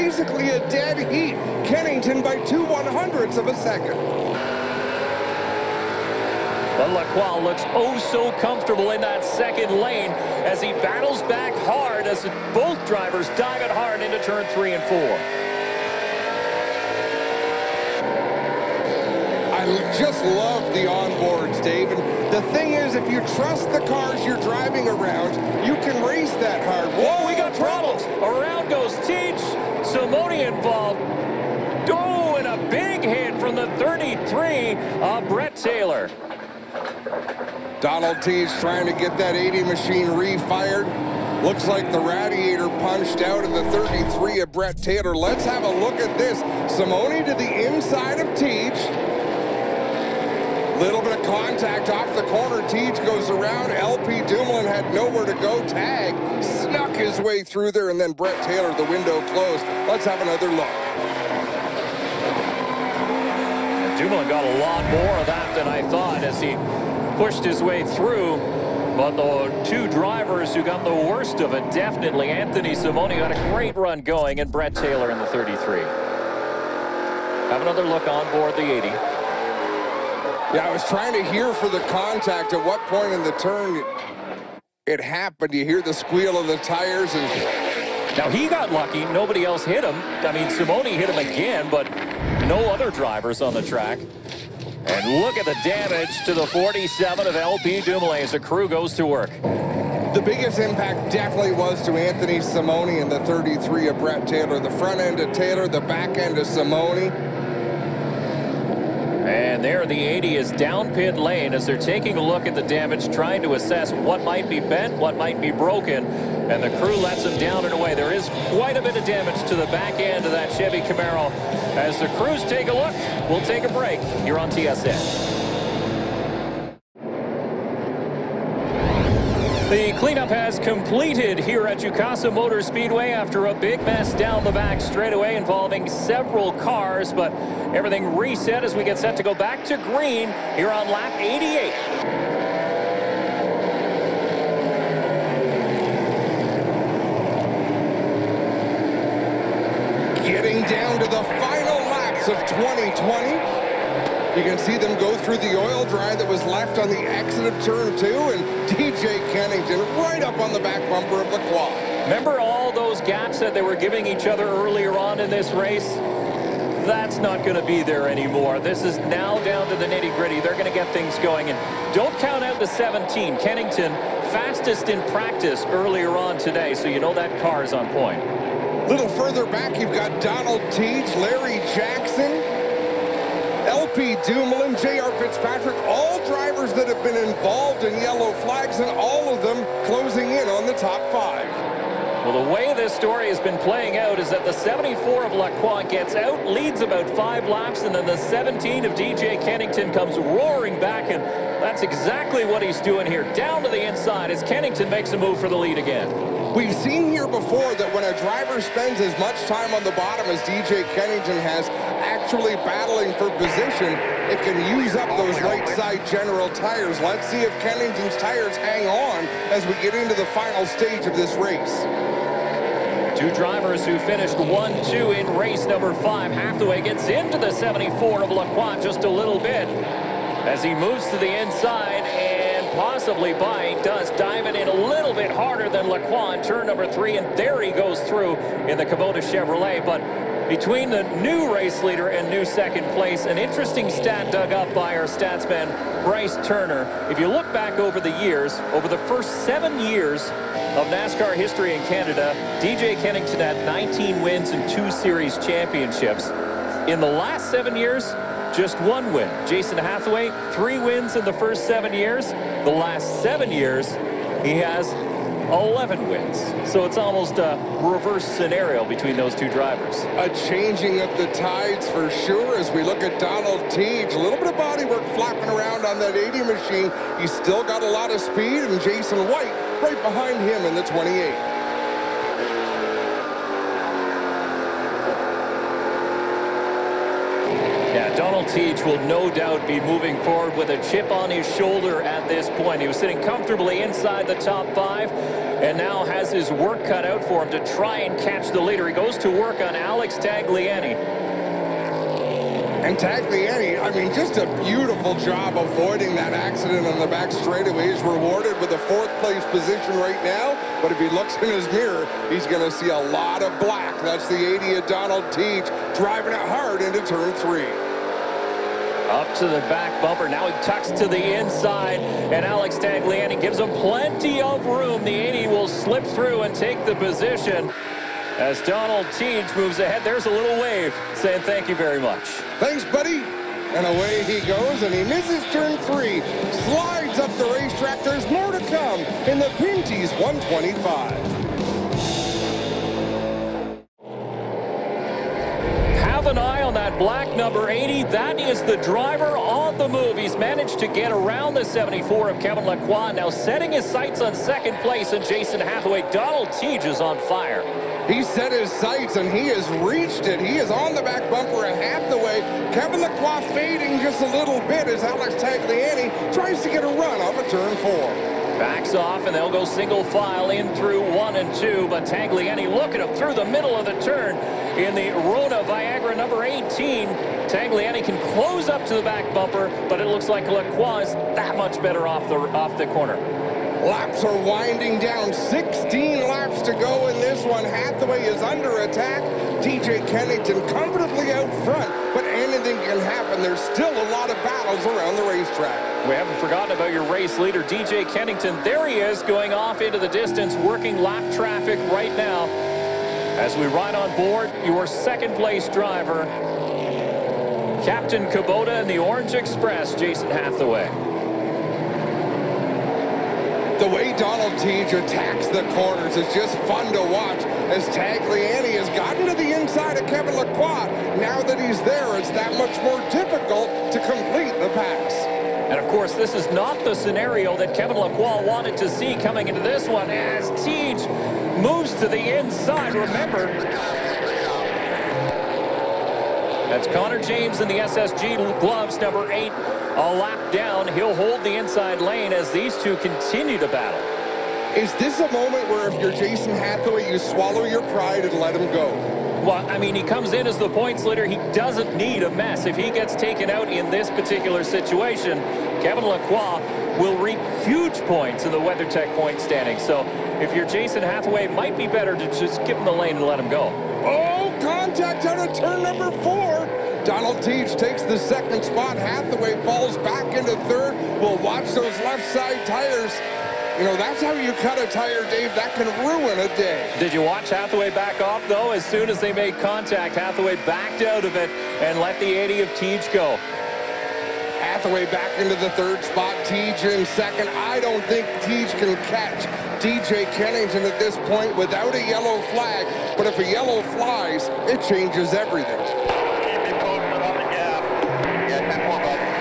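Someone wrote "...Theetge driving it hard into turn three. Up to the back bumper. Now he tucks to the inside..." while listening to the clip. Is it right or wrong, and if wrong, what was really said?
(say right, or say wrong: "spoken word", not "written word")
right.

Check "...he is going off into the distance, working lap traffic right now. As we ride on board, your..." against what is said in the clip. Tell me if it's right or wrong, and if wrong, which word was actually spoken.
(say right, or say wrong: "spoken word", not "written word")
right.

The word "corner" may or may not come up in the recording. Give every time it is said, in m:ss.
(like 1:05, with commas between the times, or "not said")
0:52, 6:22, 6:55.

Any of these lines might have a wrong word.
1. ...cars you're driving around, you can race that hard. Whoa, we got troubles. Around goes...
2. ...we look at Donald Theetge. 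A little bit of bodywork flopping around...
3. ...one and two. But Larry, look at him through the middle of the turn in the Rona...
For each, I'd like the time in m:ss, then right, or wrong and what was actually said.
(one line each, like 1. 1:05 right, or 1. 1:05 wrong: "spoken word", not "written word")
1. 0:23 right
2. 4:32 right
3. 6:11 wrong: "Tagliani", not "Larry".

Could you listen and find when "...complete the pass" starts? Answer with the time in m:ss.
7:04.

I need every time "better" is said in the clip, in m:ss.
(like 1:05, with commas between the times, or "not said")
6:21, 7:41.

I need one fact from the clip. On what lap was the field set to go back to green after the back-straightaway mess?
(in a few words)
88.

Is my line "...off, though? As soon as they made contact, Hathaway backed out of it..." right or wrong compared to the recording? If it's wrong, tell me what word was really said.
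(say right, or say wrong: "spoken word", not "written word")
right.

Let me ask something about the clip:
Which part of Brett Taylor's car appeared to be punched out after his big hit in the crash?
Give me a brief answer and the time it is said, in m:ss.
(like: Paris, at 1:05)
Radiator, at 0:42.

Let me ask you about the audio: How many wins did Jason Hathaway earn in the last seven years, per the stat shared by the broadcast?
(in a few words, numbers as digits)
11.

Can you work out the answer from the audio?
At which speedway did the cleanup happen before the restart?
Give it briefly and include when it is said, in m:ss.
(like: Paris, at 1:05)
Jukasa Motor Speedway, at 2:11.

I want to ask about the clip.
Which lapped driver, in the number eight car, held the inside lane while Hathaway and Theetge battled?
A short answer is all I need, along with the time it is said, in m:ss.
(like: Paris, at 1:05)
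Connor James, at 7:16.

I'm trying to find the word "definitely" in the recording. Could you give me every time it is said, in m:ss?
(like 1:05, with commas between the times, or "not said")
1:11, 1:41.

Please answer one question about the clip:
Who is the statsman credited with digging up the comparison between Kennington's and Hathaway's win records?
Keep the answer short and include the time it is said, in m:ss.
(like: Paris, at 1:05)
Bryce Turner, at 4:06.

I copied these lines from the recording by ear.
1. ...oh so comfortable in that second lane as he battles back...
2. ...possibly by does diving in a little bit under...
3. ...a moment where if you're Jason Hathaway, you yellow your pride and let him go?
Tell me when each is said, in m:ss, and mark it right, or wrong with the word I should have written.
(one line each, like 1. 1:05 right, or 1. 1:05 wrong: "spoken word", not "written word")
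1. 0:07 right
2. 3:52 wrong: "harder", not "under"
3. 7:25 wrong: "swallow", not "yellow".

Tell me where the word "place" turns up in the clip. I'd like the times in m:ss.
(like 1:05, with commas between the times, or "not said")
4:02, 5:09, 5:54, 6:45.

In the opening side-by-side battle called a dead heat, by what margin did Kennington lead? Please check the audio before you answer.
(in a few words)
2 one hundredths of a second.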